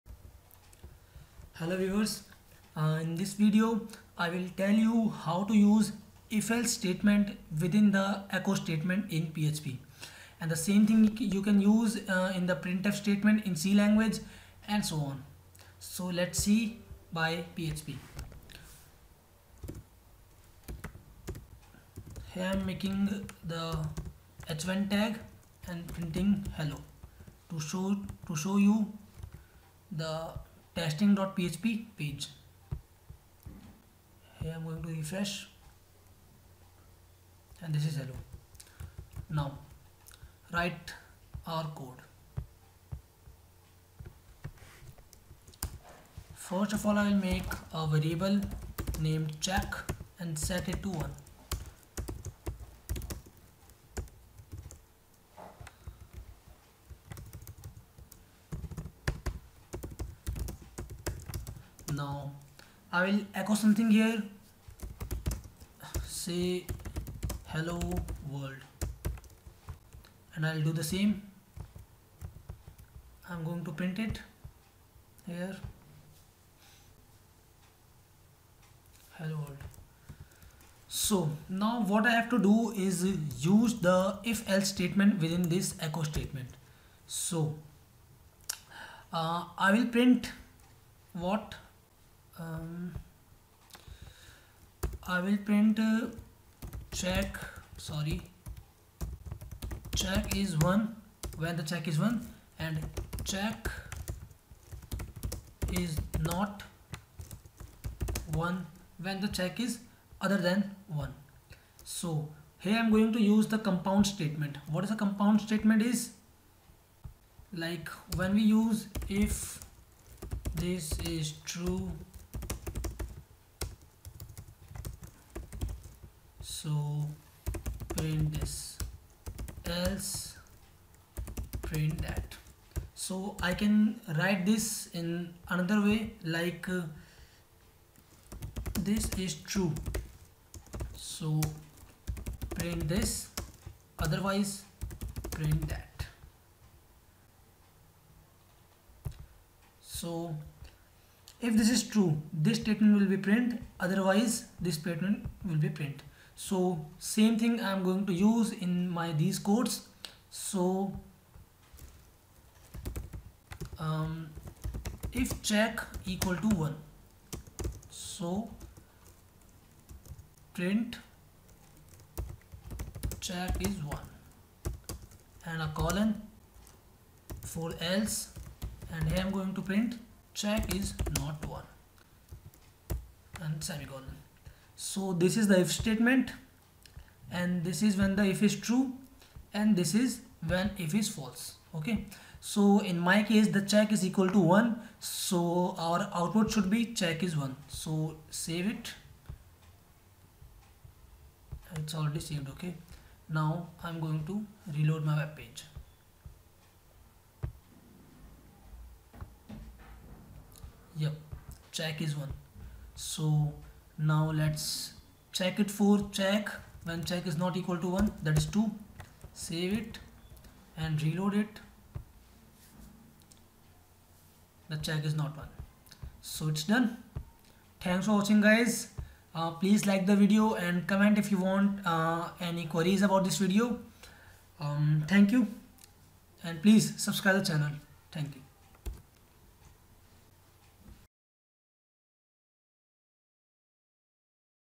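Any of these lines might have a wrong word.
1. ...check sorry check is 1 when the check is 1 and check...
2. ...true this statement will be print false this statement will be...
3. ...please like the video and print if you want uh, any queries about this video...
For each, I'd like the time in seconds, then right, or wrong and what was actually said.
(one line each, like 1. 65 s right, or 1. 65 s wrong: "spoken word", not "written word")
1. 96 s right
2. 151 s wrong: "otherwise", not "false"
3. 229 s wrong: "comment", not "print".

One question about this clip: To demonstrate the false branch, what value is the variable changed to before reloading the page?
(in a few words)
2.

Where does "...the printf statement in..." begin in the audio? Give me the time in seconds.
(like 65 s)
12 s.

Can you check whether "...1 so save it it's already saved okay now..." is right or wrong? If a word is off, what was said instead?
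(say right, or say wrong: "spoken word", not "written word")
right.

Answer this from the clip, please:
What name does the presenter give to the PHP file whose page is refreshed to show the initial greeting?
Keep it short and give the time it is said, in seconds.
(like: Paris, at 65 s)
testing.php, at 30 s.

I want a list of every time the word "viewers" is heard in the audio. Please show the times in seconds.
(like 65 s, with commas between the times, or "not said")
1 s.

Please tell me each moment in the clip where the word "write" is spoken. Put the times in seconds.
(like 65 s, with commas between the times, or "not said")
40 s, 134 s.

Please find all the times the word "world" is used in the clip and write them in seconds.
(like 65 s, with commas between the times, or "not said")
68 s, 79 s.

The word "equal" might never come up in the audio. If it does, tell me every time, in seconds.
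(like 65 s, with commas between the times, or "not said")
166 s, 194 s, 217 s.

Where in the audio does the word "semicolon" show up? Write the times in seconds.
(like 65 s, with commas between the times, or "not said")
183 s.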